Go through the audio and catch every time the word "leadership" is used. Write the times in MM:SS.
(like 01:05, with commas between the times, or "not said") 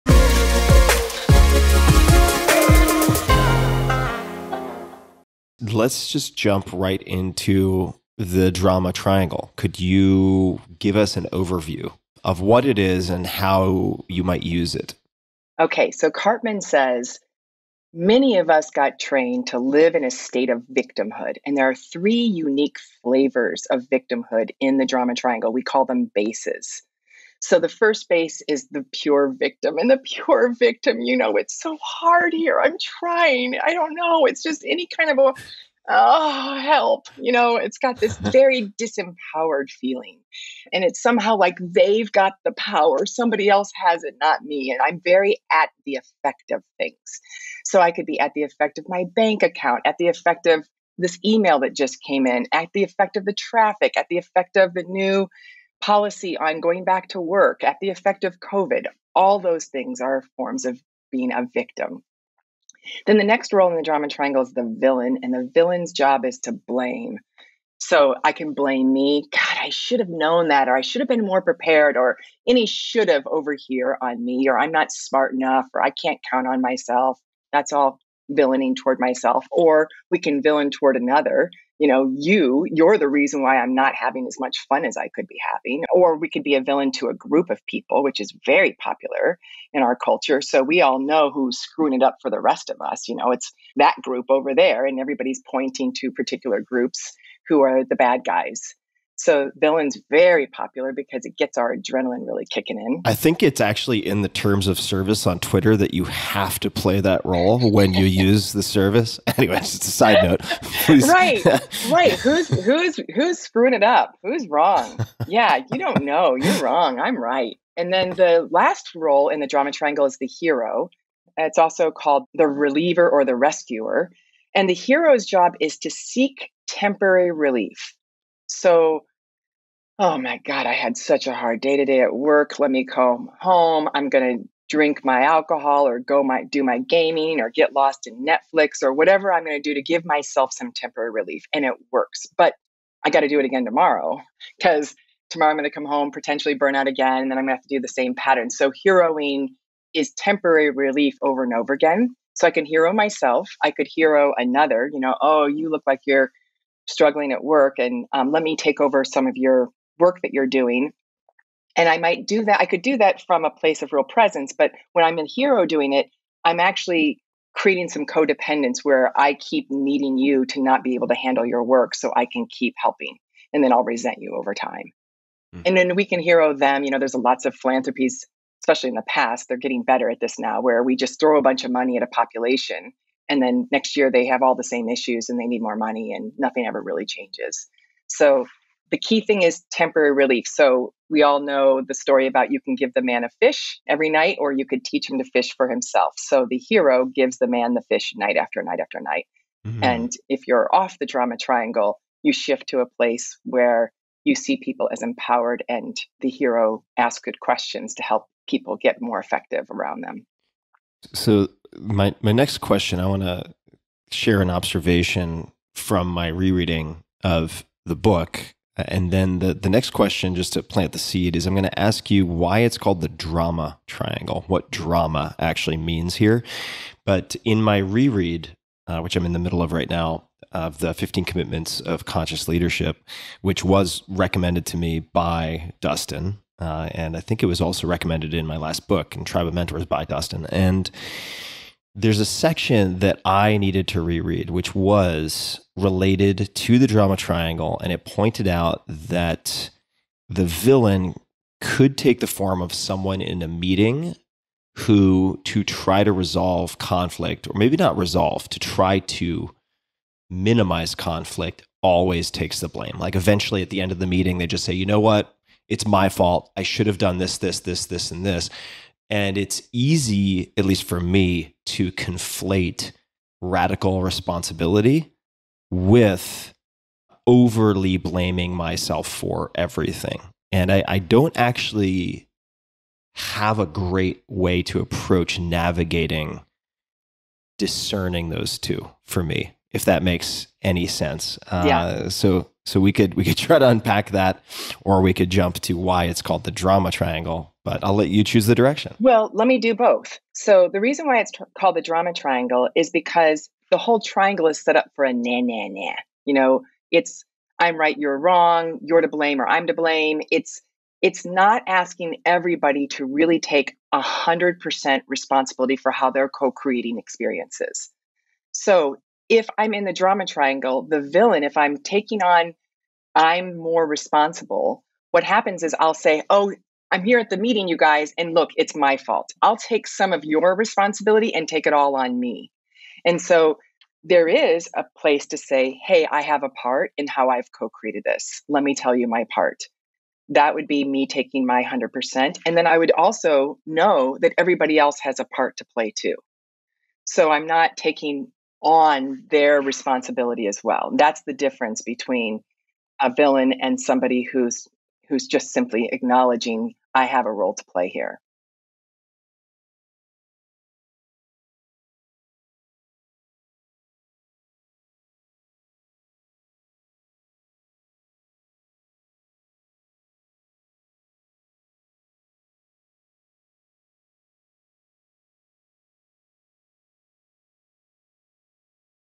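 03:52.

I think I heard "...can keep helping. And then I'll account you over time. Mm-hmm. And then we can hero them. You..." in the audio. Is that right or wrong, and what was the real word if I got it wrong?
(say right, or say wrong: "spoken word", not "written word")
wrong: "resent", not "account".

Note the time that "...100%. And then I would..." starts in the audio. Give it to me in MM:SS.
05:41.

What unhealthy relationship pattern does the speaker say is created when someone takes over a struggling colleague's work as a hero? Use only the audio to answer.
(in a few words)
Codependence.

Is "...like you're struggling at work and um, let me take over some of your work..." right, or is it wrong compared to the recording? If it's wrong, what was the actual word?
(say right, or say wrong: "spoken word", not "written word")
right.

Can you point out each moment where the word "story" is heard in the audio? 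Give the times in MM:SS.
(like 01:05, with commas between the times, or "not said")
03:11.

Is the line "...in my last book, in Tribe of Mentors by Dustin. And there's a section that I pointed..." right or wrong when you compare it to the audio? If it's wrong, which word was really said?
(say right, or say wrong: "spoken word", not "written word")
wrong: "needed", not "pointed".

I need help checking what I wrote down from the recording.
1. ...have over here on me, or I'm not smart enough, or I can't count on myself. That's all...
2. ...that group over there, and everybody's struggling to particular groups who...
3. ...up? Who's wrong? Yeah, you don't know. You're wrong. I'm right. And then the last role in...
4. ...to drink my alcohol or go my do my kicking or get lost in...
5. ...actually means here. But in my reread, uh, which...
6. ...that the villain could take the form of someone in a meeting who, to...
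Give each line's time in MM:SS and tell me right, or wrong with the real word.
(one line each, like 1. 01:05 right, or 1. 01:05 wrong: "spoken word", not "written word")
1. 01:13 right
2. 01:33 wrong: "pointing", not "struggling"
3. 01:53 right
4. 02:14 wrong: "gaming", not "kicking"
5. 03:45 right
6. 04:08 right.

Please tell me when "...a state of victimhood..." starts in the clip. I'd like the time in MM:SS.
00:20.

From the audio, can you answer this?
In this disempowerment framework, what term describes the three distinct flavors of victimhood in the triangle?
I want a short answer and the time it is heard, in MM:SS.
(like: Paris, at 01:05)
Bases, at 00:26.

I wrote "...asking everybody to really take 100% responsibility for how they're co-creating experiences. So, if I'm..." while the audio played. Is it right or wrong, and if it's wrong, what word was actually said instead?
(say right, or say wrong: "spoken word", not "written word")
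right.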